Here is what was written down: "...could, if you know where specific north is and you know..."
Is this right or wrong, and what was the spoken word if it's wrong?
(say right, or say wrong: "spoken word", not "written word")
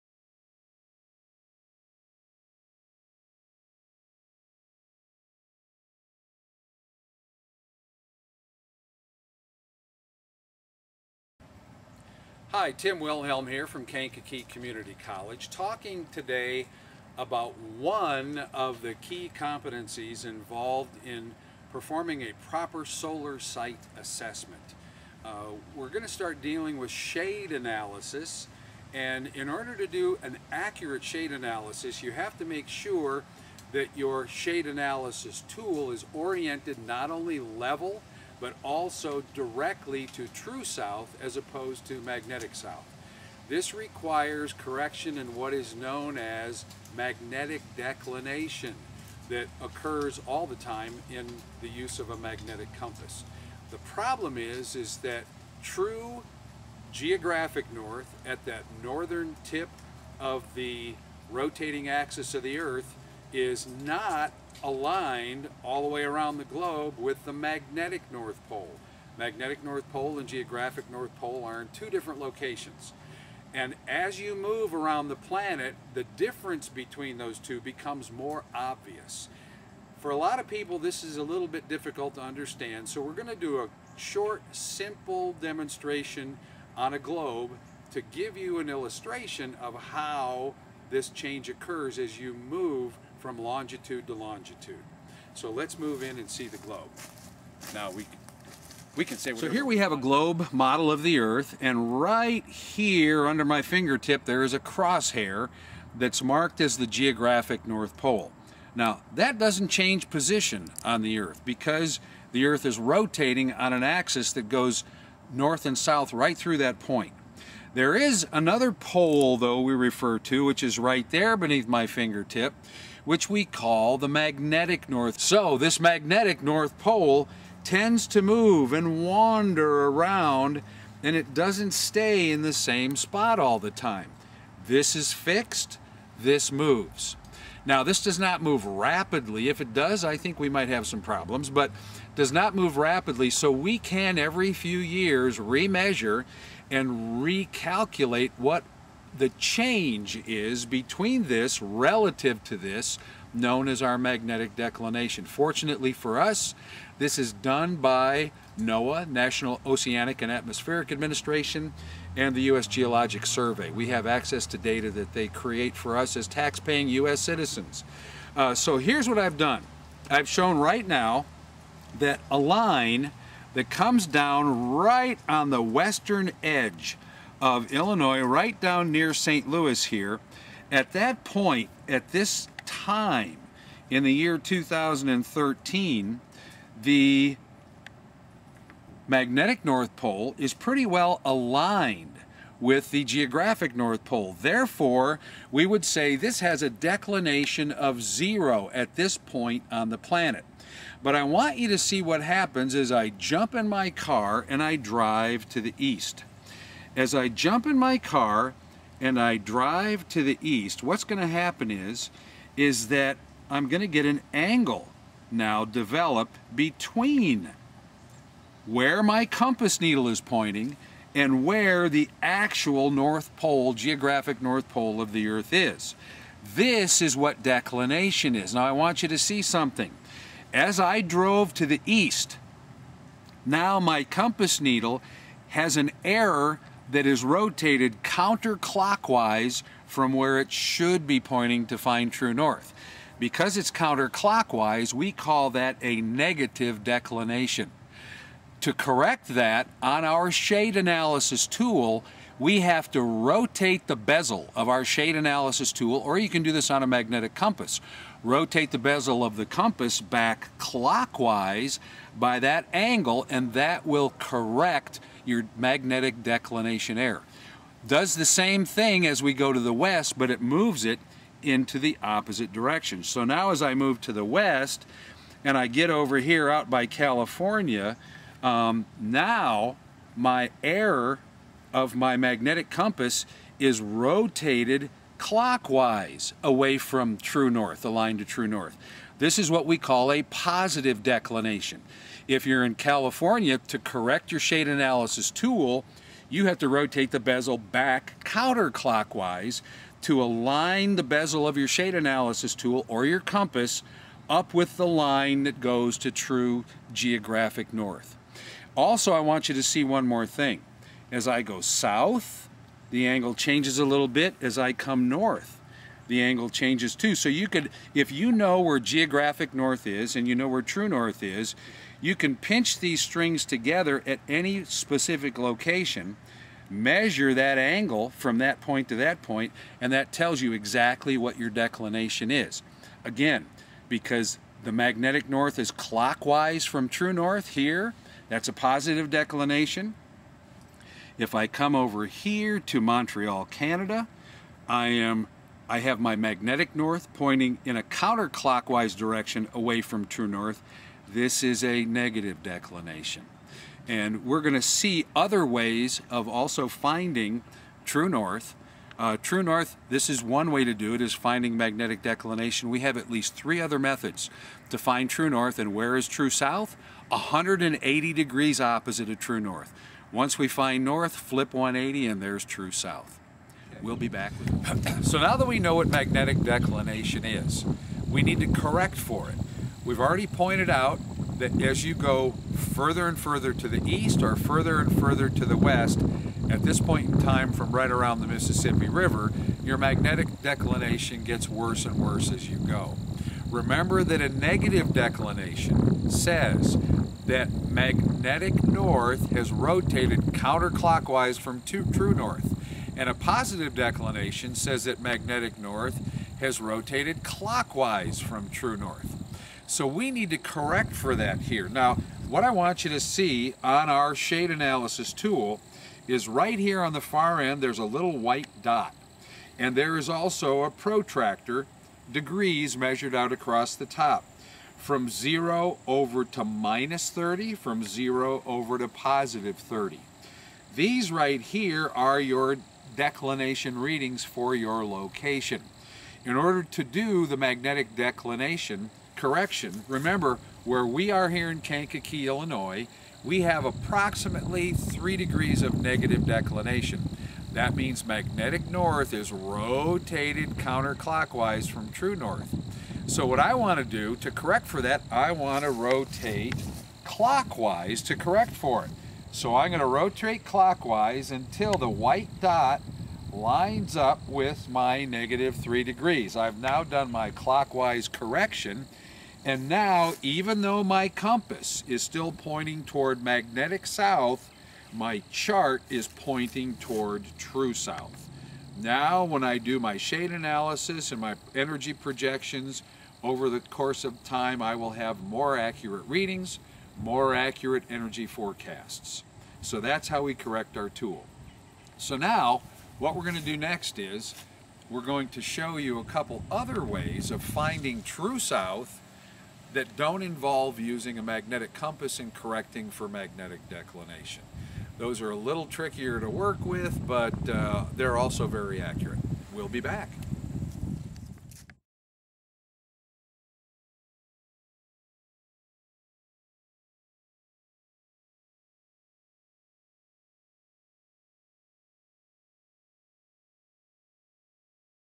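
wrong: "geographic", not "specific".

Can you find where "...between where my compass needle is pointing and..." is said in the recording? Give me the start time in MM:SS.
03:36.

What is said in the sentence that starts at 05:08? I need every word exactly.
Also, I want you to see one more thing.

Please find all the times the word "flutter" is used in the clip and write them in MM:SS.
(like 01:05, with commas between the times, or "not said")
not said.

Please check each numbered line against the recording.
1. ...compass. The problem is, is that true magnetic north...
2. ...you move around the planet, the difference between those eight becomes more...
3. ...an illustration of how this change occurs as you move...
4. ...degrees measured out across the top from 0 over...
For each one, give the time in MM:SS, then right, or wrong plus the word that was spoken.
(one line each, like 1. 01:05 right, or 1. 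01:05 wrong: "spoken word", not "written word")
1. 00:52 wrong: "geographic", not "magnetic"
2. 01:14 wrong: "two", not "eight"
3. 01:28 right
4. 07:02 right.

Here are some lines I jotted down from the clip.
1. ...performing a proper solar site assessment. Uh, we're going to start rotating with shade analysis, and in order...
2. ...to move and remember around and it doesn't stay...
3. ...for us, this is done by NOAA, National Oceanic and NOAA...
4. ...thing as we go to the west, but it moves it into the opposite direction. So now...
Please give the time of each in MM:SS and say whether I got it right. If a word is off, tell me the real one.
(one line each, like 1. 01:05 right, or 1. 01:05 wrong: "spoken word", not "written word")
1. 00:21 wrong: "dealing", not "rotating"
2. 02:08 wrong: "wander", not "remember"
3. 02:35 wrong: "Atmospheric", not "NOAA"
4. 04:28 right.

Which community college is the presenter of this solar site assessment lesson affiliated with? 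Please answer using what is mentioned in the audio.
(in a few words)
Kankakee Community College.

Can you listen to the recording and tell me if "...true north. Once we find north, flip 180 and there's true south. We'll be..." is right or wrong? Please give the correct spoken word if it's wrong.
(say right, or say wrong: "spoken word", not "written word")
right.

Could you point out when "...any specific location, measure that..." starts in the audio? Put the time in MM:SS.
05:24.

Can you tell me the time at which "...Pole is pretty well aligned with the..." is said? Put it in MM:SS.
03:09.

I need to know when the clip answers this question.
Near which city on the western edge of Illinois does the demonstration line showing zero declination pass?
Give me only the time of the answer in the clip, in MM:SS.
02:59.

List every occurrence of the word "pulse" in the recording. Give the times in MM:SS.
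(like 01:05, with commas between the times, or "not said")
not said.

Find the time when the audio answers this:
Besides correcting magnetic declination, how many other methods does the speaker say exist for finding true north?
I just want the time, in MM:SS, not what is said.
06:03.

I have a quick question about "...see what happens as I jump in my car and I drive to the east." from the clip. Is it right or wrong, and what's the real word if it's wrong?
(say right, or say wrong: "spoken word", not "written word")
right.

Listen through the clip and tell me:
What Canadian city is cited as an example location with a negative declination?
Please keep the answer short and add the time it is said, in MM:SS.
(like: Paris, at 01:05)
Montreal, at 05:42.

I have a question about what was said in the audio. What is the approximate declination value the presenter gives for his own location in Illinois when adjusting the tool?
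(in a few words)
-3 degrees.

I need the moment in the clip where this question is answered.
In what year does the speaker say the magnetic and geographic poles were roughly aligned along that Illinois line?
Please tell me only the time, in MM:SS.
03:04.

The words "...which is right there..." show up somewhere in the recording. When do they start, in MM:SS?
02:00.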